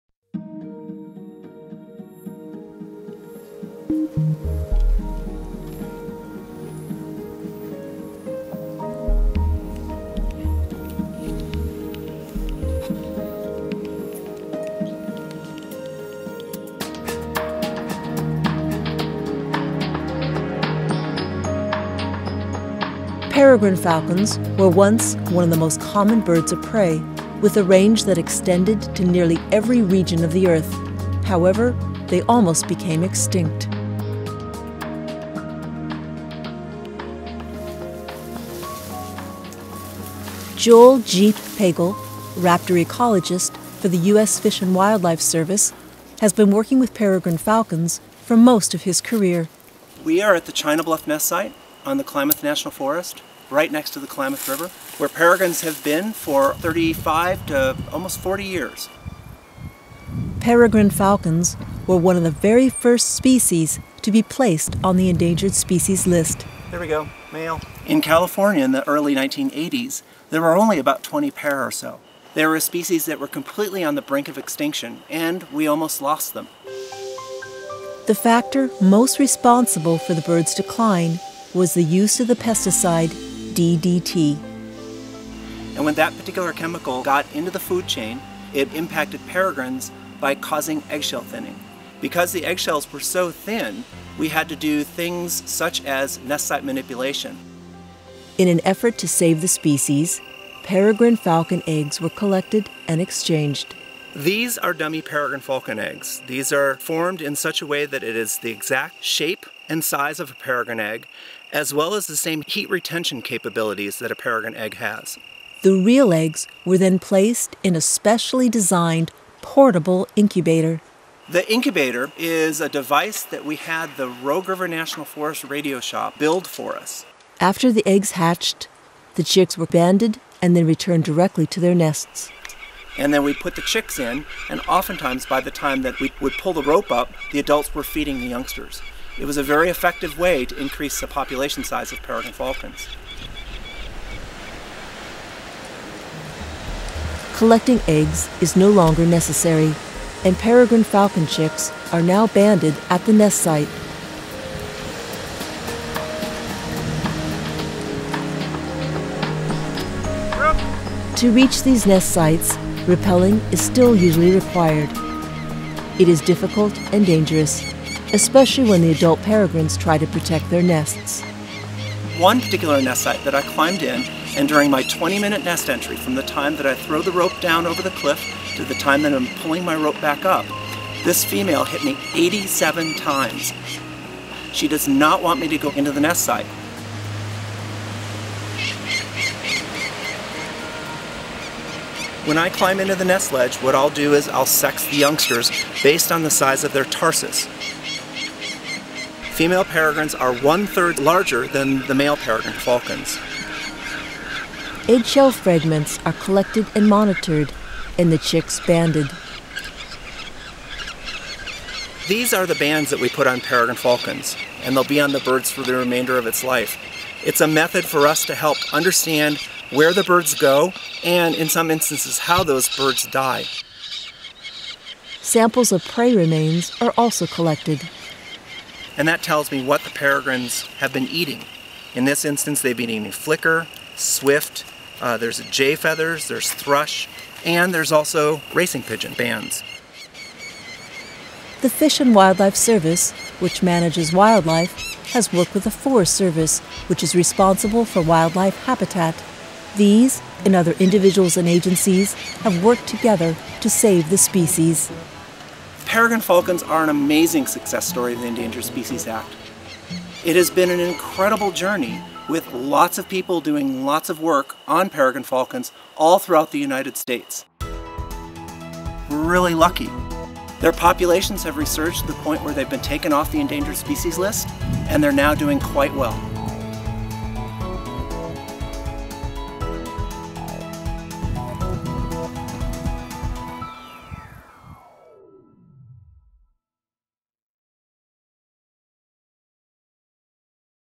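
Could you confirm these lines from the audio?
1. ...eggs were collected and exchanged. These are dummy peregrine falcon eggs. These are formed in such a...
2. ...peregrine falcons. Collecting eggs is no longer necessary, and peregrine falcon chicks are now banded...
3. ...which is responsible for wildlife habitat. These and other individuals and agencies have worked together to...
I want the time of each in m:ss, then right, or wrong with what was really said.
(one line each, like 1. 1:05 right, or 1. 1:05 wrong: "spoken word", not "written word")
1. 1:41 right
2. 2:22 right
3. 4:06 right.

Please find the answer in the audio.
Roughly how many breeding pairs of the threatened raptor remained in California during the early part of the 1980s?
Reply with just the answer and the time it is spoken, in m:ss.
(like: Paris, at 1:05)
20, at 1:10.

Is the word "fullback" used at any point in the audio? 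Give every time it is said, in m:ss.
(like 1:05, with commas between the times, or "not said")
not said.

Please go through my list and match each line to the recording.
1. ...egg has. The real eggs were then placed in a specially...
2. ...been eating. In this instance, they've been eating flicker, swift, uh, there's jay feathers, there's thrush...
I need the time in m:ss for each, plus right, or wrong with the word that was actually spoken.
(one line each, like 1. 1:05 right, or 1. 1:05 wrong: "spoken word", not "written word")
1. 1:54 right
2. 3:50 right.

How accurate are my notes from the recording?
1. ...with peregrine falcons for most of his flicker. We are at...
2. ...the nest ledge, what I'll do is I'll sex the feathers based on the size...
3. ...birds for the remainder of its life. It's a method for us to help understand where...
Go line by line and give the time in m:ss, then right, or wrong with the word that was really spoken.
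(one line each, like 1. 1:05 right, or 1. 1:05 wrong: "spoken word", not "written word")
1. 0:46 wrong: "career", not "flicker"
2. 3:12 wrong: "youngsters", not "feathers"
3. 3:35 right.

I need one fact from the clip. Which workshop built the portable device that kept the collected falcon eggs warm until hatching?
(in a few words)
Rogue River National Forest Radio Shop.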